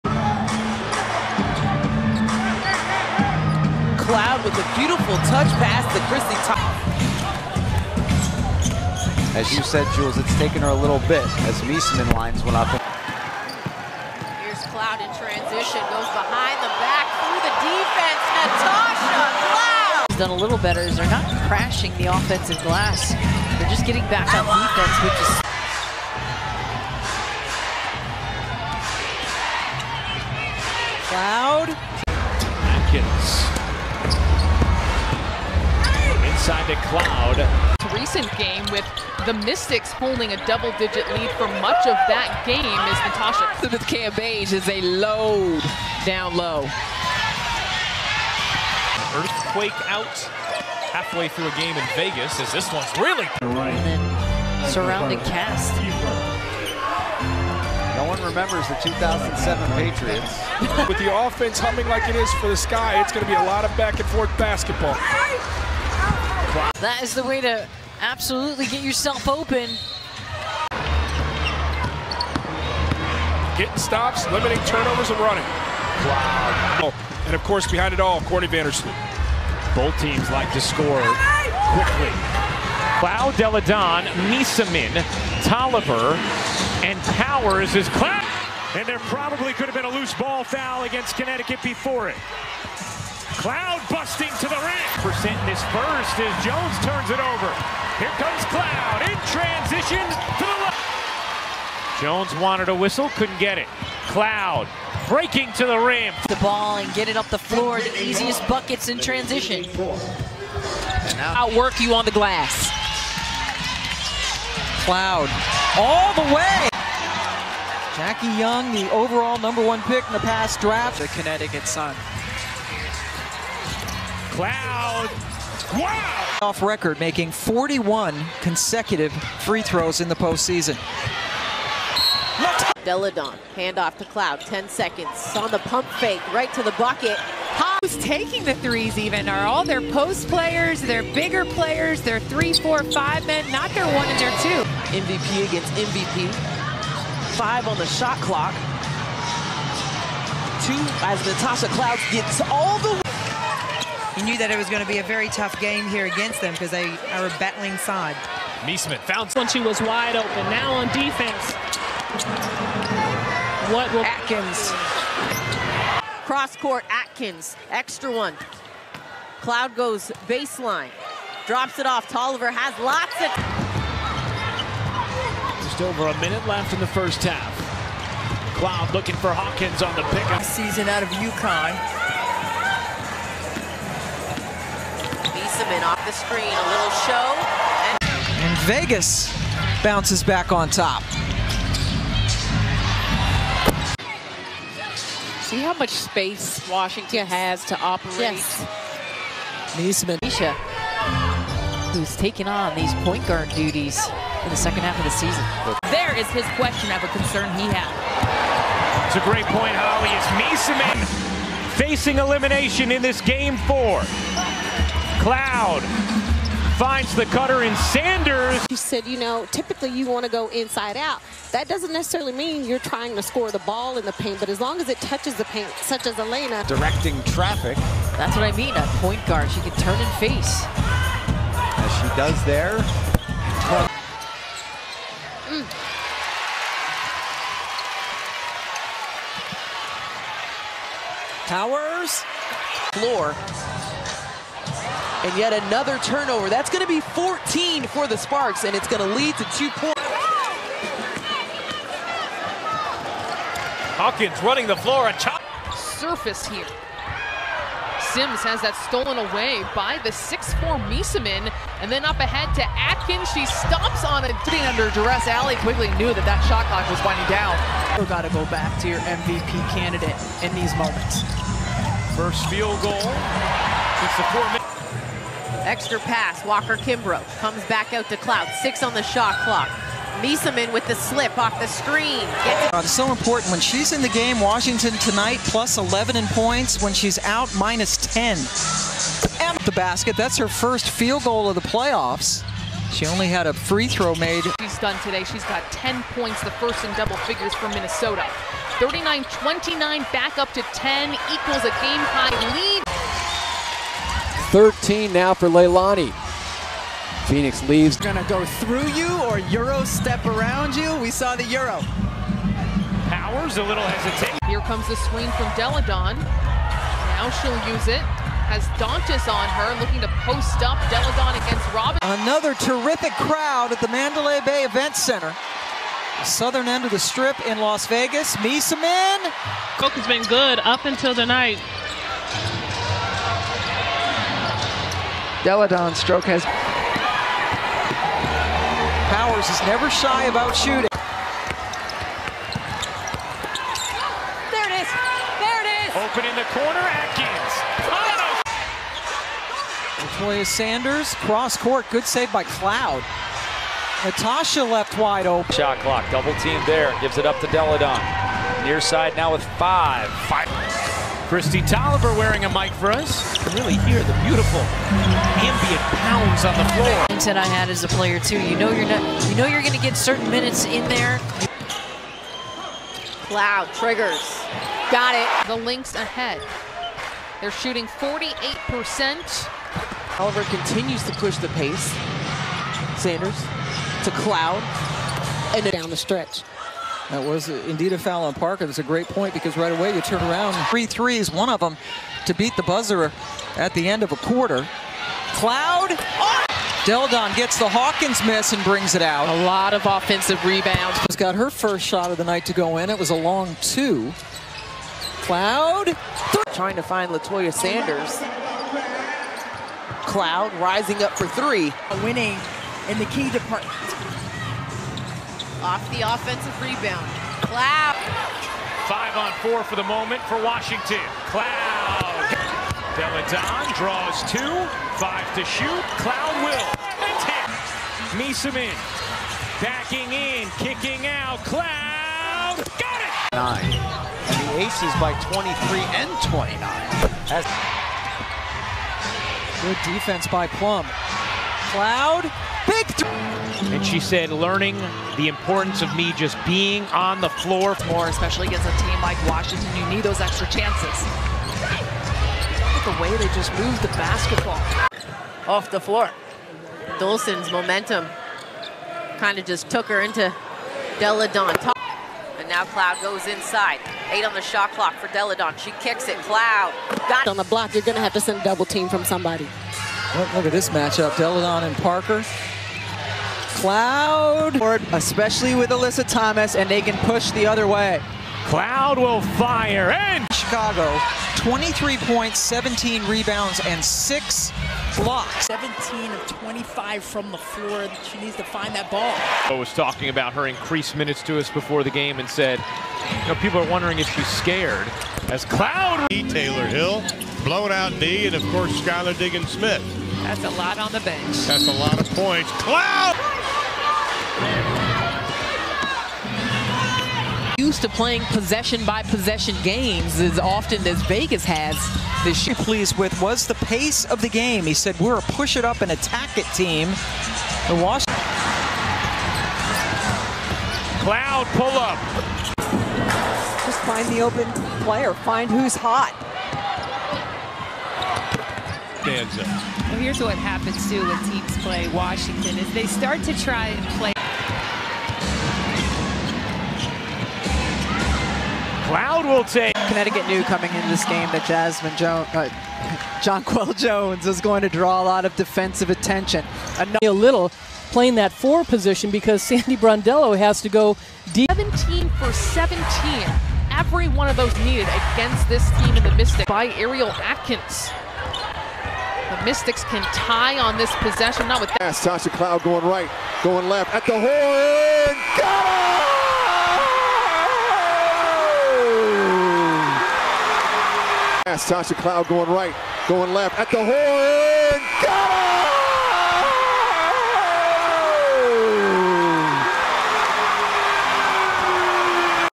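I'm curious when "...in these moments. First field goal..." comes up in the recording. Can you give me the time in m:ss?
4:30.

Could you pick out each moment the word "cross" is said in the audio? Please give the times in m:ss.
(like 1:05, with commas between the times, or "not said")
2:46, 5:51.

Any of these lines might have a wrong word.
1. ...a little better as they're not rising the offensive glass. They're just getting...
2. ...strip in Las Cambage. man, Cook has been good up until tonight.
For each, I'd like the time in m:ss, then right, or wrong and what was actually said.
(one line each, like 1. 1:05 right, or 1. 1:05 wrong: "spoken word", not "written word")
1. 0:20 wrong: "crashing", not "rising"
2. 5:26 wrong: "Vegas", not "Cambage".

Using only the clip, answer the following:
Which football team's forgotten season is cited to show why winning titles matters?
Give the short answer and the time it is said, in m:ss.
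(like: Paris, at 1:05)
2007 Patriots, at 0:58.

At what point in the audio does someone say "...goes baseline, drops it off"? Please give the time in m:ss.
2:49.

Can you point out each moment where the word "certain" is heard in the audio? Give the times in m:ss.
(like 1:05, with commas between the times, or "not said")
6:09.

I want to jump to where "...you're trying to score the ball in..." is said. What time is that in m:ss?
3:42.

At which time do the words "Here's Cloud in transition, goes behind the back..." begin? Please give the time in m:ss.
0:12.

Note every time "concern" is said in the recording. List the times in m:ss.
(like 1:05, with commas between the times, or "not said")
3:27.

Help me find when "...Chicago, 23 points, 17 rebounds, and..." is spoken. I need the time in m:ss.
8:00.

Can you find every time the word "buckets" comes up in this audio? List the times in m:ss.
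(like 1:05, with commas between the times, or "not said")
1:48, 2:16.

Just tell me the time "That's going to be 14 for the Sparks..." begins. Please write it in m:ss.
4:06.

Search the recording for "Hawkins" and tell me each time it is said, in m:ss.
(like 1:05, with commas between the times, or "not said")
2:59, 4:13, 6:37.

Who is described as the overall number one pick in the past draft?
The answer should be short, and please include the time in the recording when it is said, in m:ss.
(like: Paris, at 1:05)
Jackie Young, at 1:57.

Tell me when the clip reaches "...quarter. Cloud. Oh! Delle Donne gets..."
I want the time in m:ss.
6:34.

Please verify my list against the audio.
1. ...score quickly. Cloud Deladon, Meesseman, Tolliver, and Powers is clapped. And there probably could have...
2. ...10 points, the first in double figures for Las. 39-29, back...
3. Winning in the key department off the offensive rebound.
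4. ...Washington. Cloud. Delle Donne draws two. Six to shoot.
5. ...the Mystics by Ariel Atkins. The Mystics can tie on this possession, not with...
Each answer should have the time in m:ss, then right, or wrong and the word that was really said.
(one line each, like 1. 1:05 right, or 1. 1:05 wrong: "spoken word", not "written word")
1. 1:20 right
2. 4:55 wrong: "Minnesota", not "Las"
3. 6:52 right
4. 7:00 wrong: "Five", not "Six"
5. 9:16 right.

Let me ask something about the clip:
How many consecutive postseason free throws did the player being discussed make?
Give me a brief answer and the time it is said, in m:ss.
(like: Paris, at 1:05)
41, at 2:07.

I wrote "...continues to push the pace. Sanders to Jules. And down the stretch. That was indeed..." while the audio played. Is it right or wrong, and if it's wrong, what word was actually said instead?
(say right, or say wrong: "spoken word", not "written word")
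wrong: "Cloud", not "Jules".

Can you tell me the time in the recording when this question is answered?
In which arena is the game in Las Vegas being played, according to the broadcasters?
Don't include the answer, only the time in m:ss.
5:23.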